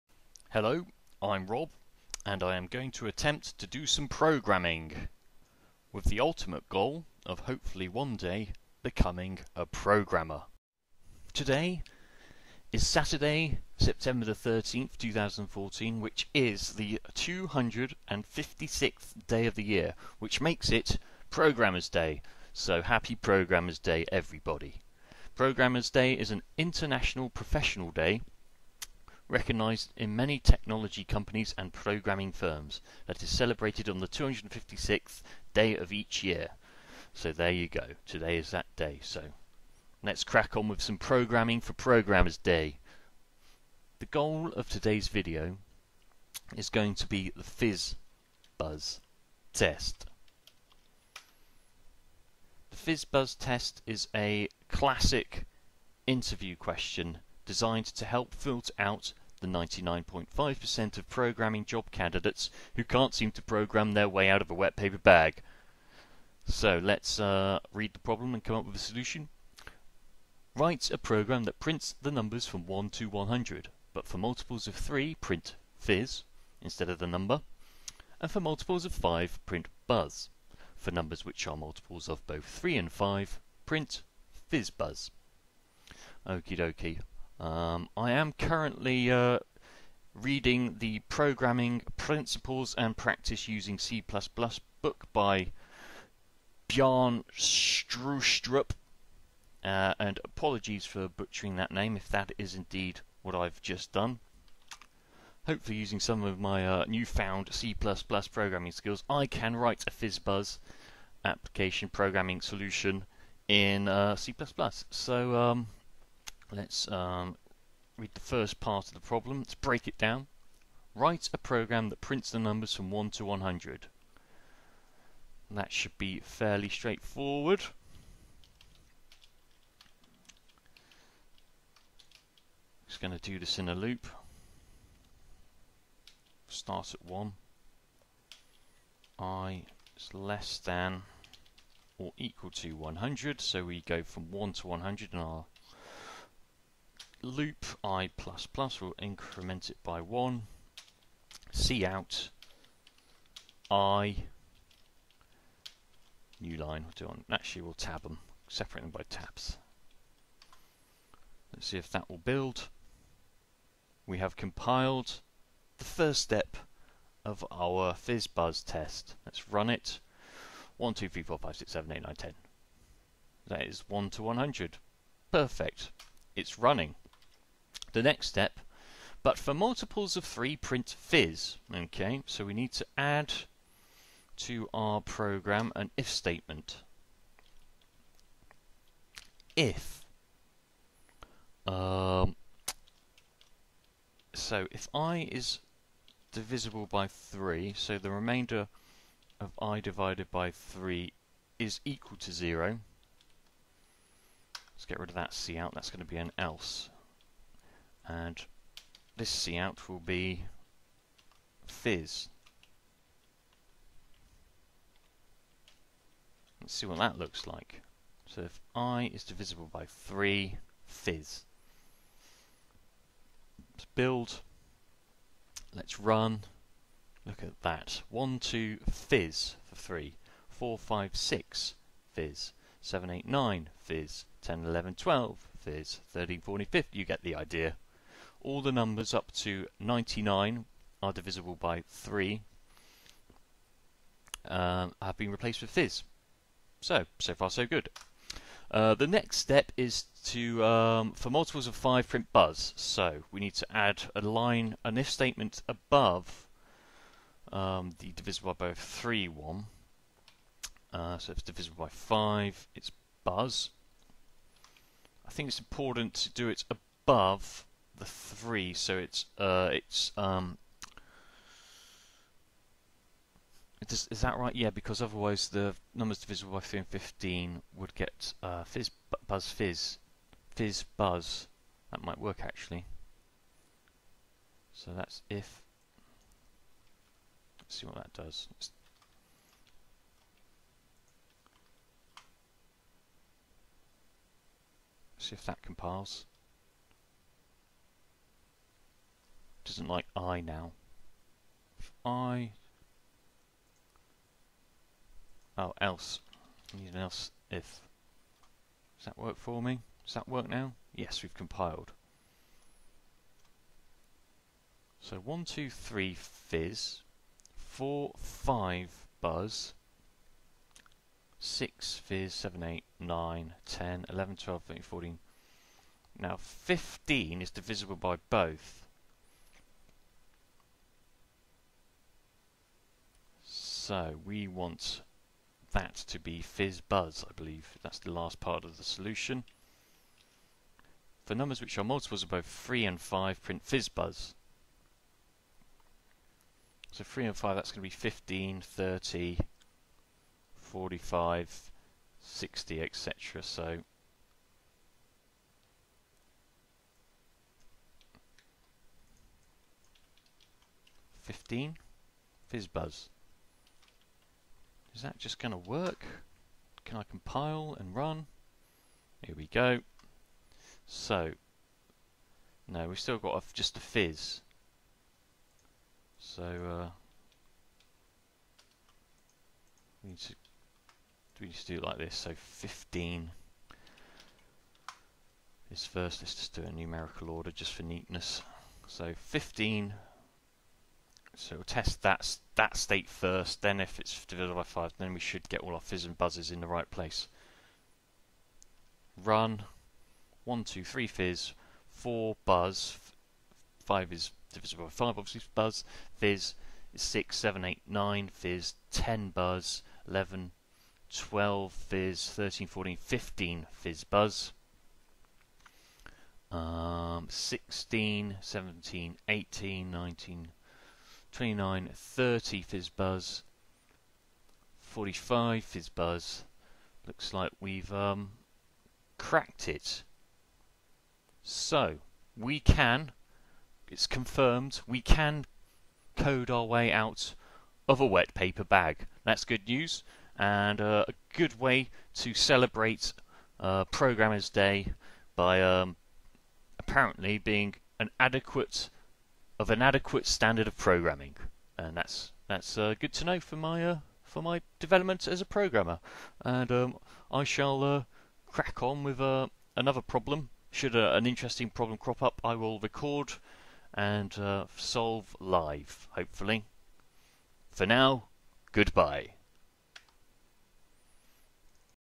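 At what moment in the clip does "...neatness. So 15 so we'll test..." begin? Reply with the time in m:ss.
6:27.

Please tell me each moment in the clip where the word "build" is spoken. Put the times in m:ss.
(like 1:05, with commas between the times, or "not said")
2:42, 3:43.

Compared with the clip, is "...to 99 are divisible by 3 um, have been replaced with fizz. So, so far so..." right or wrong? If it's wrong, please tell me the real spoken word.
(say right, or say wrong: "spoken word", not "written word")
right.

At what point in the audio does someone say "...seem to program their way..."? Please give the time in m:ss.
1:03.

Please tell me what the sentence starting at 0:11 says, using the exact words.
Today is Saturday, September the 13th, 2014, which is the 256th day of the year, which makes it Programmer's Day.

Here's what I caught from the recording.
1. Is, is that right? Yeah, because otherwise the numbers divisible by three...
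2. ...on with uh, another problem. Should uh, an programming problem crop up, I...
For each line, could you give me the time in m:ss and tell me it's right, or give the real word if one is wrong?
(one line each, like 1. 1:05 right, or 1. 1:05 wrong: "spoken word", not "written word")
1. 4:33 right
2. 7:38 wrong: "interesting", not "programming".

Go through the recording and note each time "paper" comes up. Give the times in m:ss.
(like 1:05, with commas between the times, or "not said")
1:04, 7:18.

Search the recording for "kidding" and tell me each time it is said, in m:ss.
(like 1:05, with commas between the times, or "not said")
not said.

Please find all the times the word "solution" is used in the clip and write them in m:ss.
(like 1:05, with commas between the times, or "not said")
1:08, 1:52, 5:38.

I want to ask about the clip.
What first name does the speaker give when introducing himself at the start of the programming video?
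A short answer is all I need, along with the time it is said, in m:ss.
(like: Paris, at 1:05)
Rob, at 0:01.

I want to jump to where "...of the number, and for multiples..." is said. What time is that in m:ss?
1:16.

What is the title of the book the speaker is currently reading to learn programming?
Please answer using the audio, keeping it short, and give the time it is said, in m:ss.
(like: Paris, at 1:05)
Programming Principles and Practice Using C++, at 1:31.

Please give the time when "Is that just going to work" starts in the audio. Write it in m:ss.
6:04.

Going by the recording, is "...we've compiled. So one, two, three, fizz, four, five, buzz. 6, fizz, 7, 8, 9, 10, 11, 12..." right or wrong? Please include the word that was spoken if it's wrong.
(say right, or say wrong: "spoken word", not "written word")
right.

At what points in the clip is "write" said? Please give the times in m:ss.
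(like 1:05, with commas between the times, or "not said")
1:10, 1:49, 2:00.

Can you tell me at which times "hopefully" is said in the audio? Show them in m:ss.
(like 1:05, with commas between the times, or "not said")
0:07, 1:45, 7:46.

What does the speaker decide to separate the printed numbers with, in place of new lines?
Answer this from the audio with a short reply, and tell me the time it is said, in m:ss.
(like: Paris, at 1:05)
tabs, at 2:39.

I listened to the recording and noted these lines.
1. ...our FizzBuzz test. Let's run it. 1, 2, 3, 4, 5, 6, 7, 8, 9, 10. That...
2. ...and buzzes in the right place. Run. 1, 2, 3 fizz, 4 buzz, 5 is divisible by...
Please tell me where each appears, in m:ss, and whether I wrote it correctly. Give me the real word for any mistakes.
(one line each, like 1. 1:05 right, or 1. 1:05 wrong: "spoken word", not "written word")
1. 2:47 right
2. 6:36 right.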